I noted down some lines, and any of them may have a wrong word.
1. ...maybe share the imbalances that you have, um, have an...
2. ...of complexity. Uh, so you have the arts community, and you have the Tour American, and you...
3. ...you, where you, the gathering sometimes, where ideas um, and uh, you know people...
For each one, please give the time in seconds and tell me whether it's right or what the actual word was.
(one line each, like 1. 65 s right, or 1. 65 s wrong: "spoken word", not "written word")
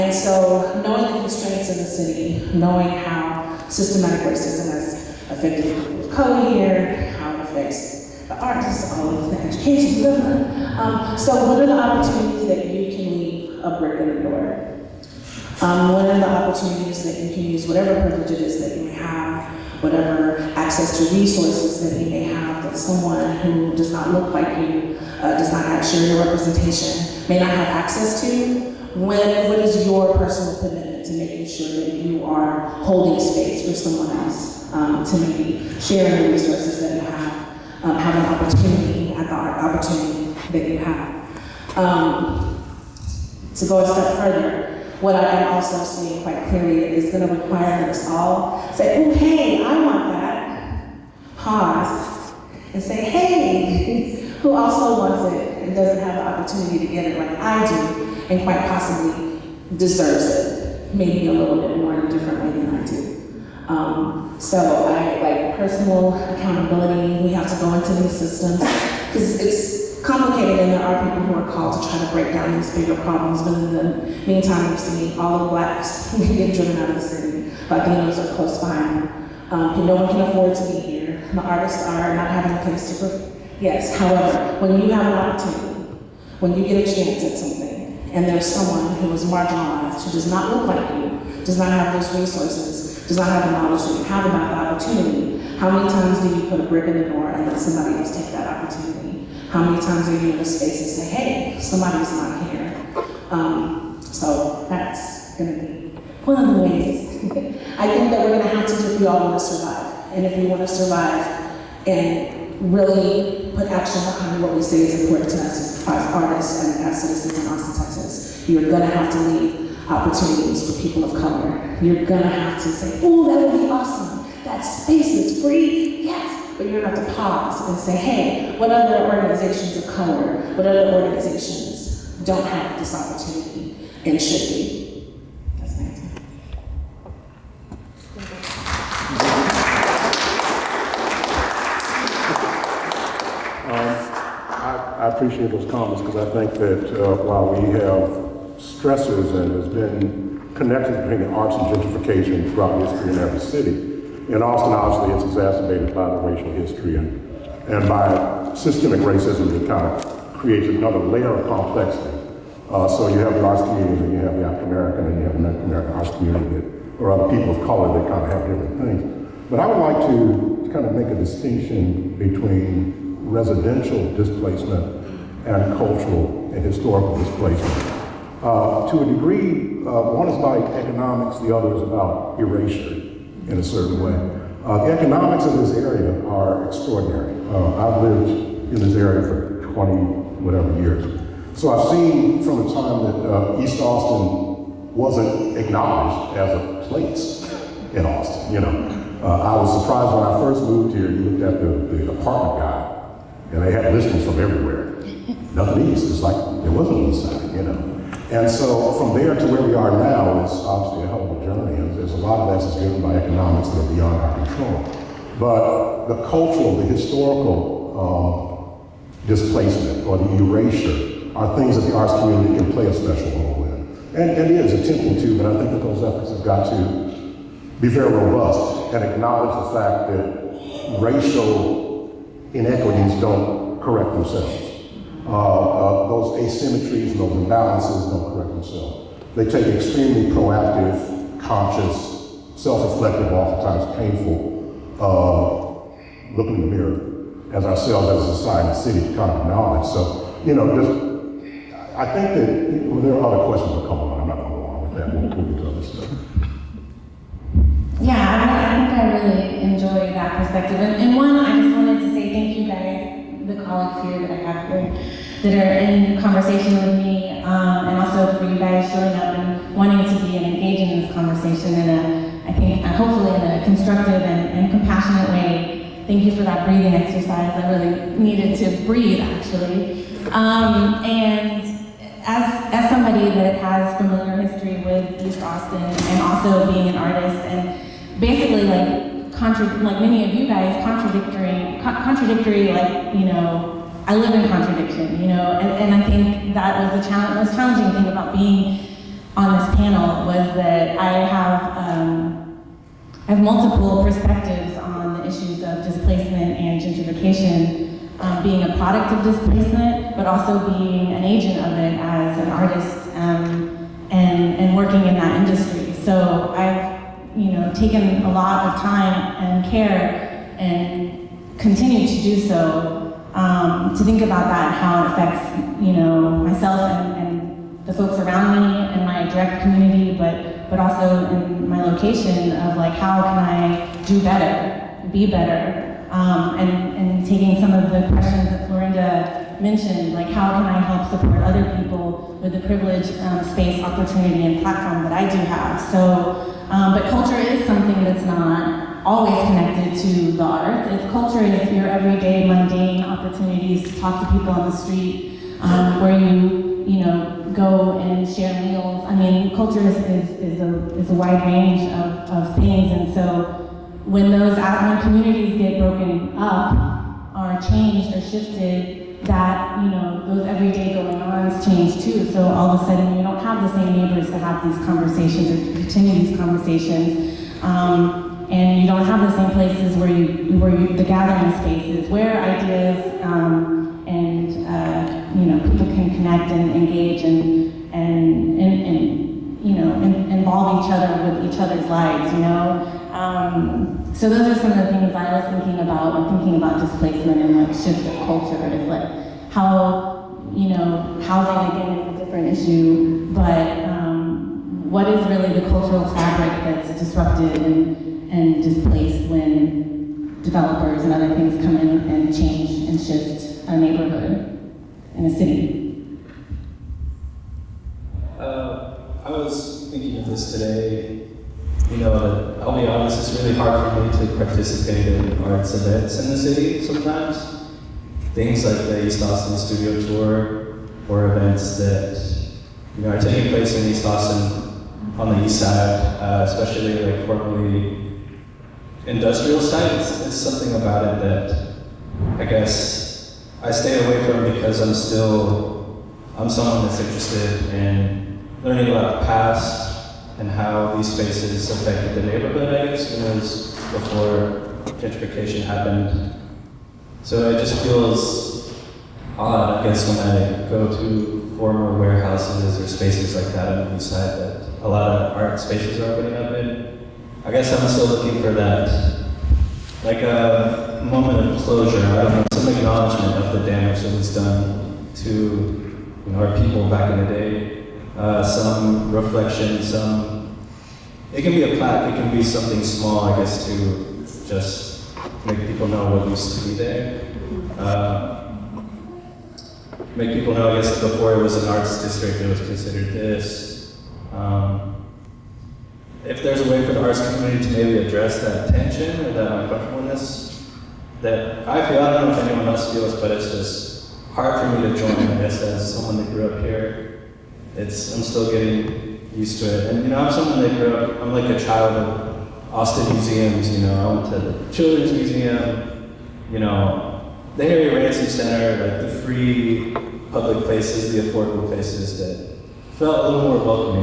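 1. 35 s wrong: "resources", not "imbalances"
2. 161 s wrong: "African", not "Tour"
3. 380 s wrong: "spaces", not "sometimes".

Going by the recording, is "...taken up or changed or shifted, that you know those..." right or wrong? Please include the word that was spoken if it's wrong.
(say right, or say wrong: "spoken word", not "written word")
wrong: "broken", not "taken".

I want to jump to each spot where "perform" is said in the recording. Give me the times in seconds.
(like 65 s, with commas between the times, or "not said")
83 s.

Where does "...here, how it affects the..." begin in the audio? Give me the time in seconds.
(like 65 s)
6 s.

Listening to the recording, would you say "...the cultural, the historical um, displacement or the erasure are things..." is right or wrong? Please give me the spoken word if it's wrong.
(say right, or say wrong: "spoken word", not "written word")
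right.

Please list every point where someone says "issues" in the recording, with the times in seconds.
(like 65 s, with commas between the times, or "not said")
305 s, 402 s.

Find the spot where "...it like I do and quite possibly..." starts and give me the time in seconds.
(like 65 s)
57 s.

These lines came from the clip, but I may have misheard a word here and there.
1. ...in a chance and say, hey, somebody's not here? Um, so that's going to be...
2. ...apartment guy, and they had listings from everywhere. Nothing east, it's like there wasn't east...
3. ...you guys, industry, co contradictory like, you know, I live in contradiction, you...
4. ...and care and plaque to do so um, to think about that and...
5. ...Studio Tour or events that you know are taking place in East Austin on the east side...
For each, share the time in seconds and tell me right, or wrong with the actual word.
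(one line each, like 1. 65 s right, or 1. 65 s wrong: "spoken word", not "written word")
1. 100 s wrong: "space", not "chance"
2. 202 s right
3. 290 s wrong: "contradictory", not "industry"
4. 319 s wrong: "continue", not "plaque"
5. 429 s right.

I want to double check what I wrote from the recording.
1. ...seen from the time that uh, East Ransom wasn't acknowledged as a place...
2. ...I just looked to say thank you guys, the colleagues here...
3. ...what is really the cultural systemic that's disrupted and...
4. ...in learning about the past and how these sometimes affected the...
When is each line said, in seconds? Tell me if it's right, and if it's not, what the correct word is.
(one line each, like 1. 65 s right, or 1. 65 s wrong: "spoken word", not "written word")
1. 191 s wrong: "Austin", not "Ransom"
2. 261 s wrong: "wanted", not "looked"
3. 404 s wrong: "fabric", not "systemic"
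4. 447 s wrong: "spaces", not "sometimes".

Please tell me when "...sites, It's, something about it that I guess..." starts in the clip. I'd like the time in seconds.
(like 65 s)
439 s.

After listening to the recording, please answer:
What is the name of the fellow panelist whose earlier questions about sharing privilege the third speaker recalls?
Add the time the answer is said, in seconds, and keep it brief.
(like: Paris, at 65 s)
Florinda, at 338 s.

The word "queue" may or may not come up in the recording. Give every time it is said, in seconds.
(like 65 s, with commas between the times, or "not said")
not said.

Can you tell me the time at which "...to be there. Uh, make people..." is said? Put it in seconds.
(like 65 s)
486 s.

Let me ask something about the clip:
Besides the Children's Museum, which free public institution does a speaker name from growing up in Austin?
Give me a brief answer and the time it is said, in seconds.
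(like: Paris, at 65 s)
Harry Ransom Center, at 517 s.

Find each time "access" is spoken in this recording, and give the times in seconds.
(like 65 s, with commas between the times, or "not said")
20 s, 27 s.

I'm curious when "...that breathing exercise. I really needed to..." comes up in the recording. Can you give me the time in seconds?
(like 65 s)
276 s.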